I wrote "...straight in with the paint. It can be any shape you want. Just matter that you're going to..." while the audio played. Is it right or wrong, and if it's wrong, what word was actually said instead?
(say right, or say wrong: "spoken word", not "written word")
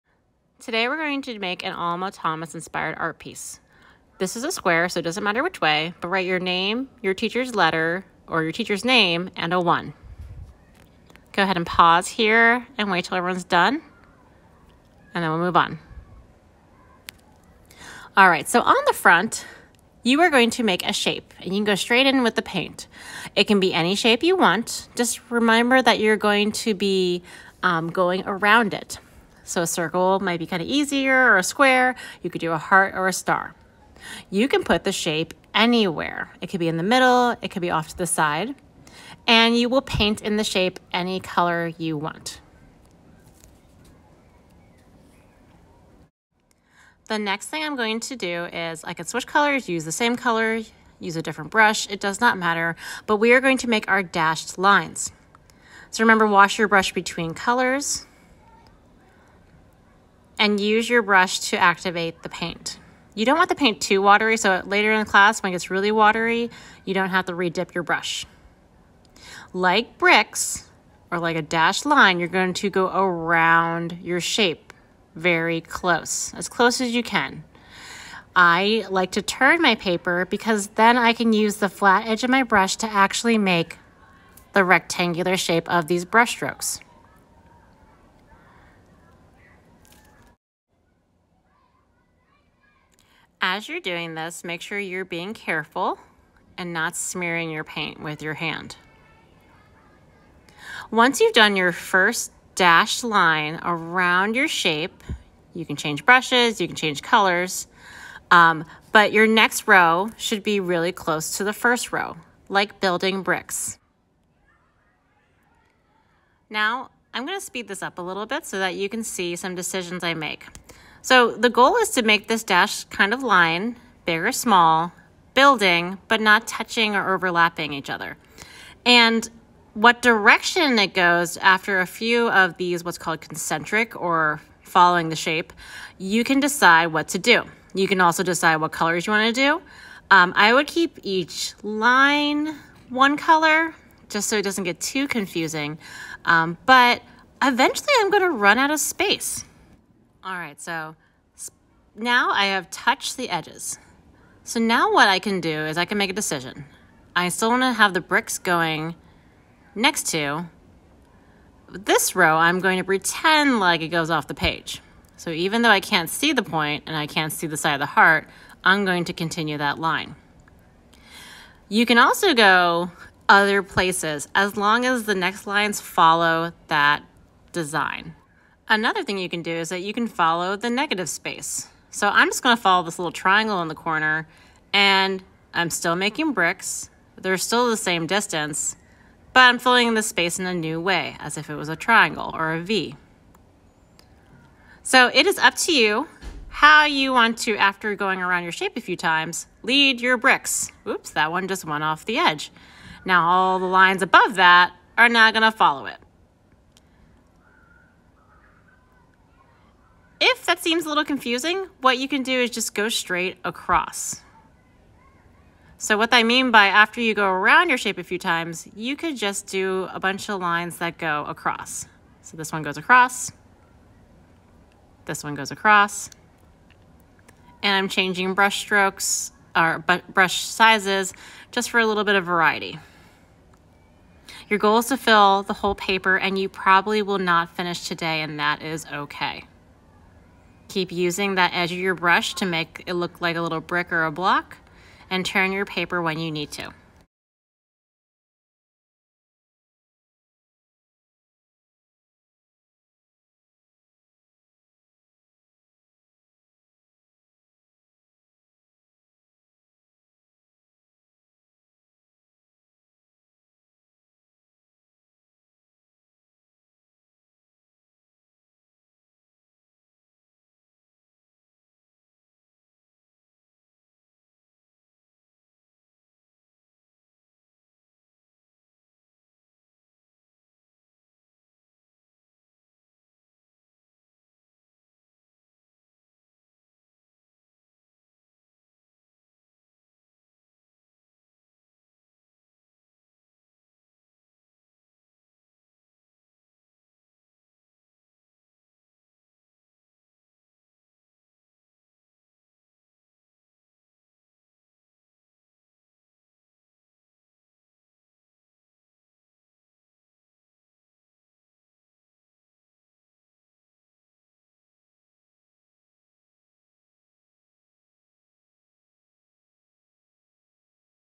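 wrong: "remember", not "matter".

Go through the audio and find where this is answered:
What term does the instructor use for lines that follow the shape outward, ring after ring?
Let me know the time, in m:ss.
2:13.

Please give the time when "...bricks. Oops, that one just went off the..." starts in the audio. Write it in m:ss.
3:20.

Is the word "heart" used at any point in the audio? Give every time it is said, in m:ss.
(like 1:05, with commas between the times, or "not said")
0:32, 2:47.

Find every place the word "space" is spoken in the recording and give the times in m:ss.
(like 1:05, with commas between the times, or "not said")
2:28, 3:01, 3:10.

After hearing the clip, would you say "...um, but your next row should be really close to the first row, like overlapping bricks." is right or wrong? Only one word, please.
wrong.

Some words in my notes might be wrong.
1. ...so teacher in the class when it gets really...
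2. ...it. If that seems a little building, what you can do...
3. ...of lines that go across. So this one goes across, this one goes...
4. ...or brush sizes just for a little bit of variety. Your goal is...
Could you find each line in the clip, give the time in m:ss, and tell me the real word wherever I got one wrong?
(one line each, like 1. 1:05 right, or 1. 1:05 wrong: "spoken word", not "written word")
1. 1:04 wrong: "later", not "teacher"
2. 3:25 wrong: "confusing", not "building"
3. 3:40 right
4. 3:49 right.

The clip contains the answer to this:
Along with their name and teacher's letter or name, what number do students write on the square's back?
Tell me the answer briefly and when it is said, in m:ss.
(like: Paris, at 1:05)
1, at 0:09.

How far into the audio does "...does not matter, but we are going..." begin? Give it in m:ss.
0:51.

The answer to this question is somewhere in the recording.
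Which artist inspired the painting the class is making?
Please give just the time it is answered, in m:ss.
0:01.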